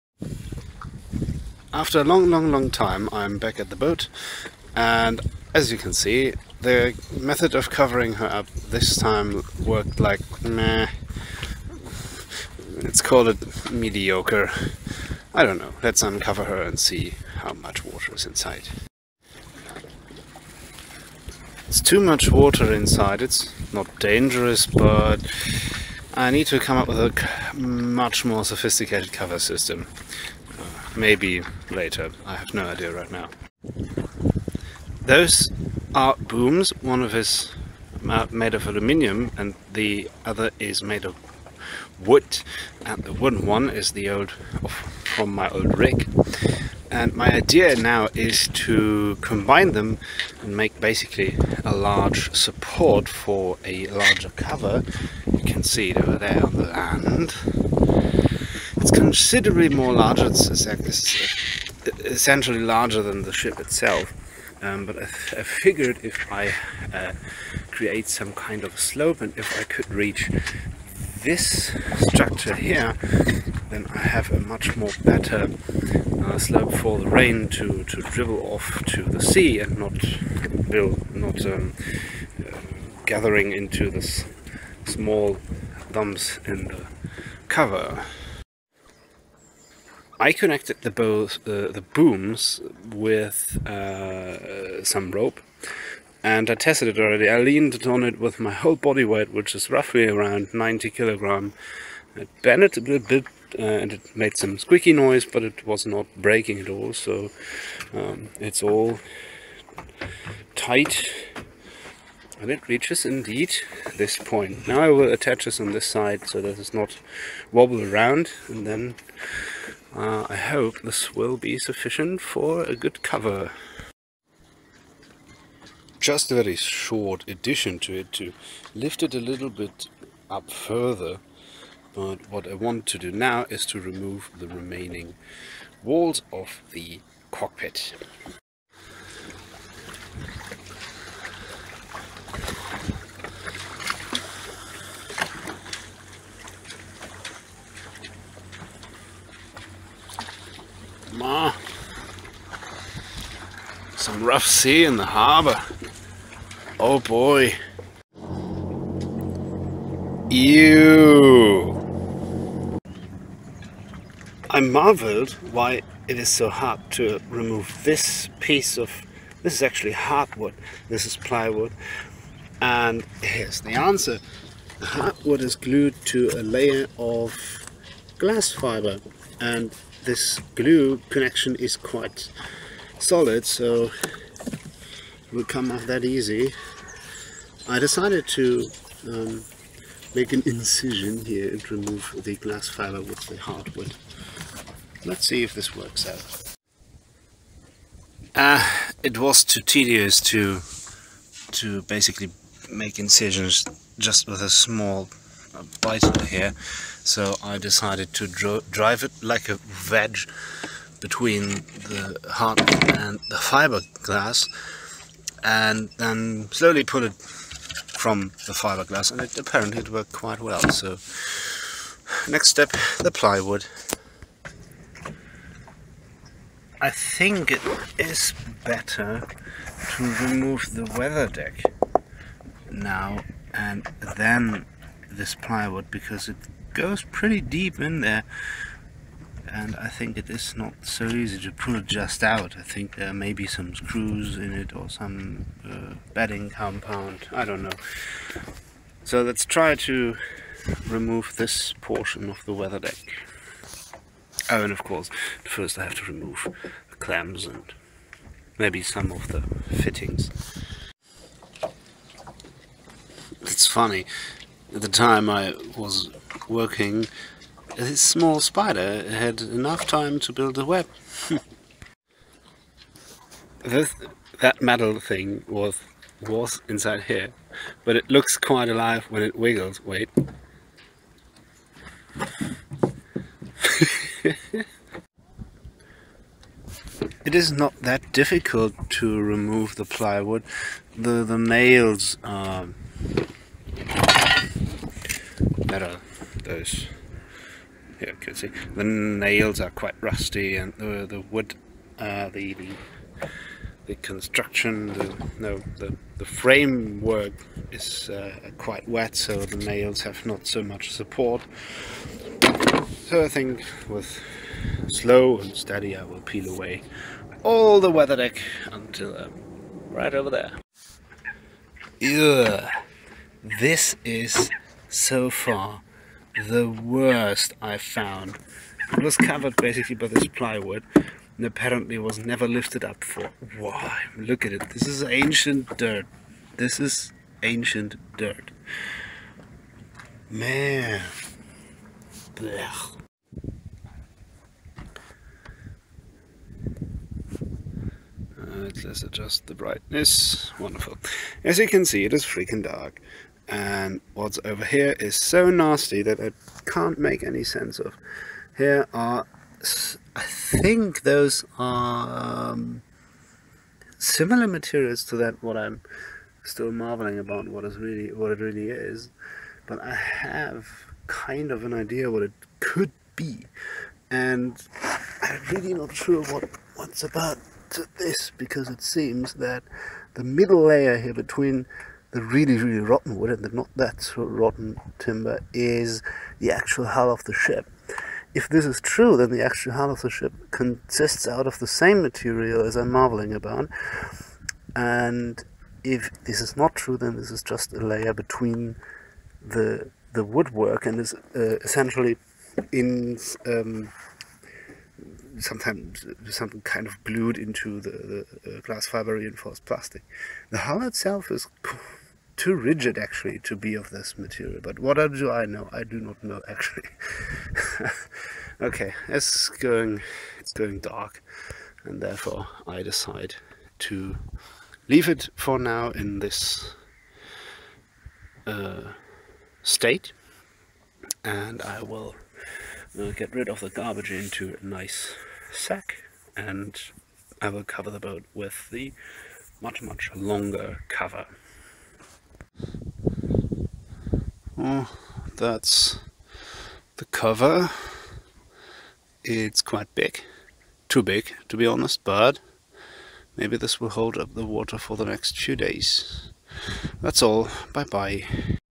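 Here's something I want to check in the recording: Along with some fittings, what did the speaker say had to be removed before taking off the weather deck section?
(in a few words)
The clams.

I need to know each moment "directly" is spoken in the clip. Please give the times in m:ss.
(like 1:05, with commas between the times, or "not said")
not said.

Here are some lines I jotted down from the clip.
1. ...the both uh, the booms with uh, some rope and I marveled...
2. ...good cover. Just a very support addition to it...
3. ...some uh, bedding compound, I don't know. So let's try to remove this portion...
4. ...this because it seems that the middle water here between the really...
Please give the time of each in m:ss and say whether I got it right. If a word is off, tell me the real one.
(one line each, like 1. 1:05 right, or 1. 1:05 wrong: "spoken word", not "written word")
1. 1:30 wrong: "tested", not "marveled"
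2. 2:02 wrong: "short", not "support"
3. 4:04 right
4. 6:17 wrong: "layer", not "water".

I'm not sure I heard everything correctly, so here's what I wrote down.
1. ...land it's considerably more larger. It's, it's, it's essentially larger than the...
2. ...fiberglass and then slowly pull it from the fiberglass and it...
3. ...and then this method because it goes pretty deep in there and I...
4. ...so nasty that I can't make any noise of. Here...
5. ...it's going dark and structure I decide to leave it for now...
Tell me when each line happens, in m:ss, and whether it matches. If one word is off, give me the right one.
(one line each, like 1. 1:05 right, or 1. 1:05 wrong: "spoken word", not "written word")
1. 0:56 right
2. 3:33 right
3. 3:53 wrong: "plywood", not "method"
4. 5:55 wrong: "sense", not "noise"
5. 7:00 wrong: "therefore", not "structure".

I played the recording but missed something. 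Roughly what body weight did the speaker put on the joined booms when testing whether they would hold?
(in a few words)
90 kilograms.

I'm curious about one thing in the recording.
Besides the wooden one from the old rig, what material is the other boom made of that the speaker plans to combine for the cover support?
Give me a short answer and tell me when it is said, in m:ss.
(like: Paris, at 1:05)
Aluminium, at 0:38.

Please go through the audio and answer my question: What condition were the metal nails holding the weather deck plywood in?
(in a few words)
Rusty.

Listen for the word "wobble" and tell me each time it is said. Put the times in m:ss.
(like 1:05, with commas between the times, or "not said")
1:57.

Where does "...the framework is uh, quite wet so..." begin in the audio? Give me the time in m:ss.
5:06.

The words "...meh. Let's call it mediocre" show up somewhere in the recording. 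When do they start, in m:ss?
0:10.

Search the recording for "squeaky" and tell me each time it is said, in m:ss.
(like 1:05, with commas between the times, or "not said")
1:44.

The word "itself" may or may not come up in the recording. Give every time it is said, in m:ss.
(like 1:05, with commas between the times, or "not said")
1:03, 6:50.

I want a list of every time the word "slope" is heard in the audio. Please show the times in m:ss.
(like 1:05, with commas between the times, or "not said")
1:08, 1:16.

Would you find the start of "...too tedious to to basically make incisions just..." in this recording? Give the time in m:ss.
3:19.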